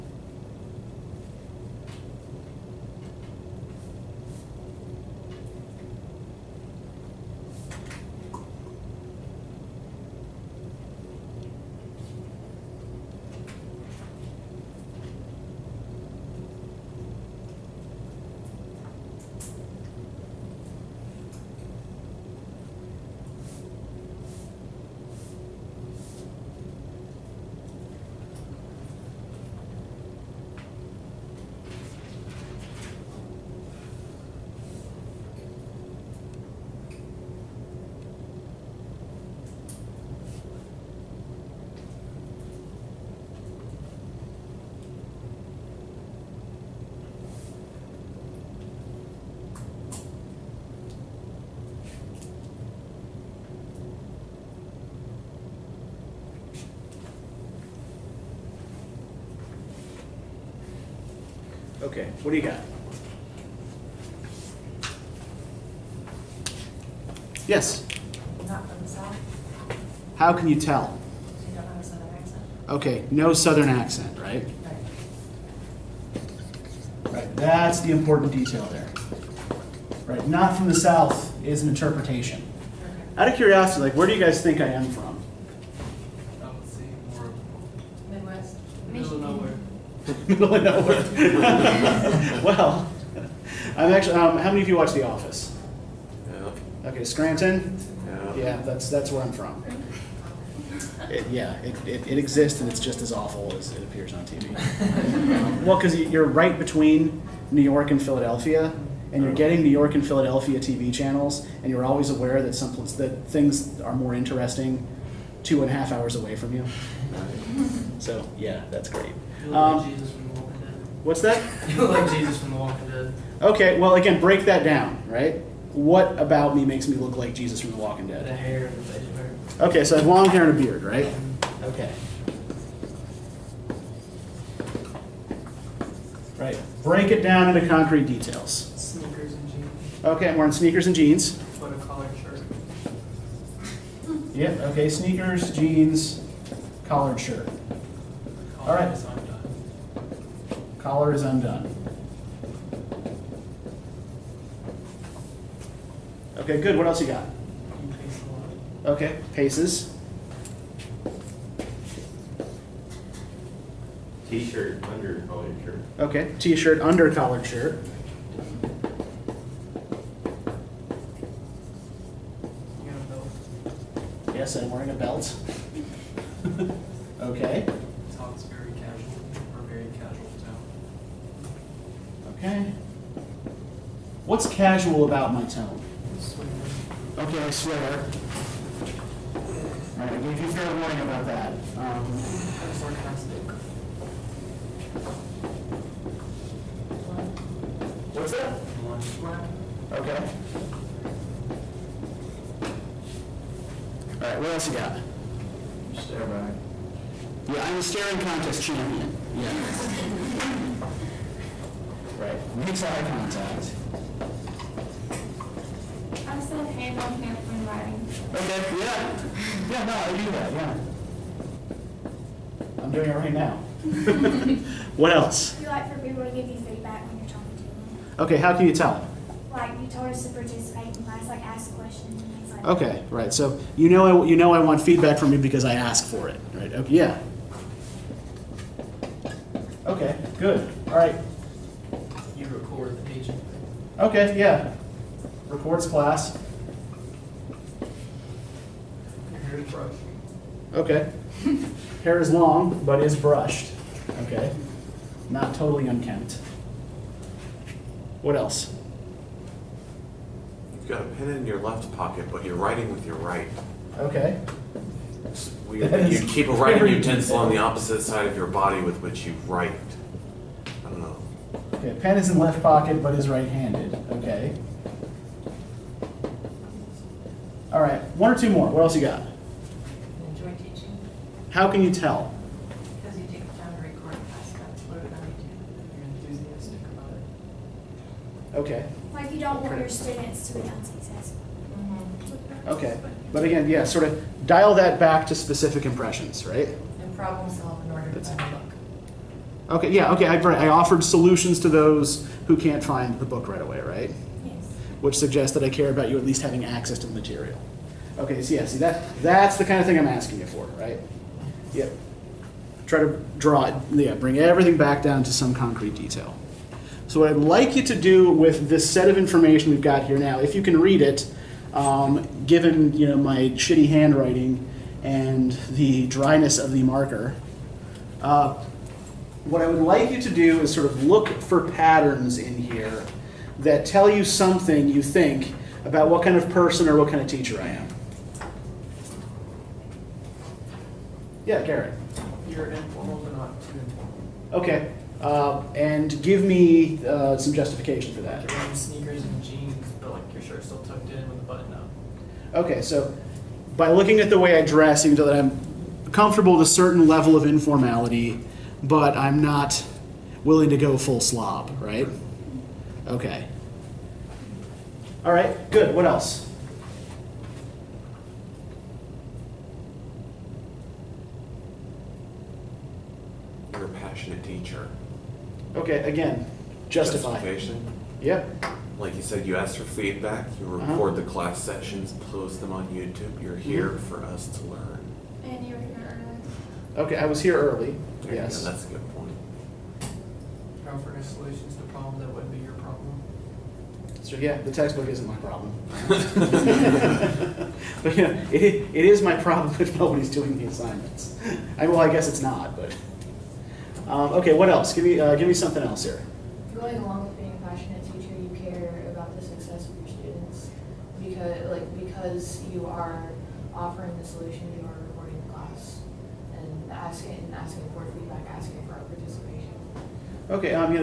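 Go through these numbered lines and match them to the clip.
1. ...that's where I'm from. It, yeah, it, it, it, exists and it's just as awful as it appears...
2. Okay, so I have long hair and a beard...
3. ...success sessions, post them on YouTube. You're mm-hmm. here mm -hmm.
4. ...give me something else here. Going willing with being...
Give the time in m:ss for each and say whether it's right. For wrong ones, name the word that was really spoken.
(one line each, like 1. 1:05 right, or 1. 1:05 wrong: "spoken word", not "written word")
1. 1:38 right
2. 2:09 right
3. 6:21 wrong: "class", not "success"
4. 6:45 wrong: "along", not "willing".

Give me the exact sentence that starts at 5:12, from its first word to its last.
Try to draw it, yeah, bring everything back down to some concrete detail.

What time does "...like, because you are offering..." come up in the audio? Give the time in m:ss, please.
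6:51.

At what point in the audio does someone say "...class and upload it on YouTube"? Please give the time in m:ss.
4:44.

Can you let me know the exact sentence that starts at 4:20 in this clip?
You've got a pen in your left pocket, but you're writing with your right.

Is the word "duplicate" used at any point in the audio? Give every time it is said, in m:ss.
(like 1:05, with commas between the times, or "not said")
not said.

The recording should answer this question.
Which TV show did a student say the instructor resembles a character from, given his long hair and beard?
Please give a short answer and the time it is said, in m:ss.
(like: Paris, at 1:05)
The Walking Dead, at 2:02.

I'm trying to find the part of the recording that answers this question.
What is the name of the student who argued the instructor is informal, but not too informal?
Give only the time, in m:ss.
5:41.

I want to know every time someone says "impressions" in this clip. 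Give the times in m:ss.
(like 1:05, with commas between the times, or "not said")
4:55.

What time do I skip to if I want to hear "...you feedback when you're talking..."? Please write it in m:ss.
3:46.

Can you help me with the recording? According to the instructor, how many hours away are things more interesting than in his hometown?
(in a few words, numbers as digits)
2.5.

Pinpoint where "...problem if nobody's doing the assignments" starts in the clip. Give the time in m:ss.
6:39.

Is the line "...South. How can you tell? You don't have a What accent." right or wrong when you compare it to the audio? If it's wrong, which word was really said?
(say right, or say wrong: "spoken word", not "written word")
wrong: "Southern", not "What".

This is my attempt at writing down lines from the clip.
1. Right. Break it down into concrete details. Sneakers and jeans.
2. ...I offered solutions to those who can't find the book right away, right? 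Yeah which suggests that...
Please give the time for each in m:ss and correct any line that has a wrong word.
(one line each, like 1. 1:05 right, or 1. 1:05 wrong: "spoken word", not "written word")
1. 2:16 right
2. 5:00 right.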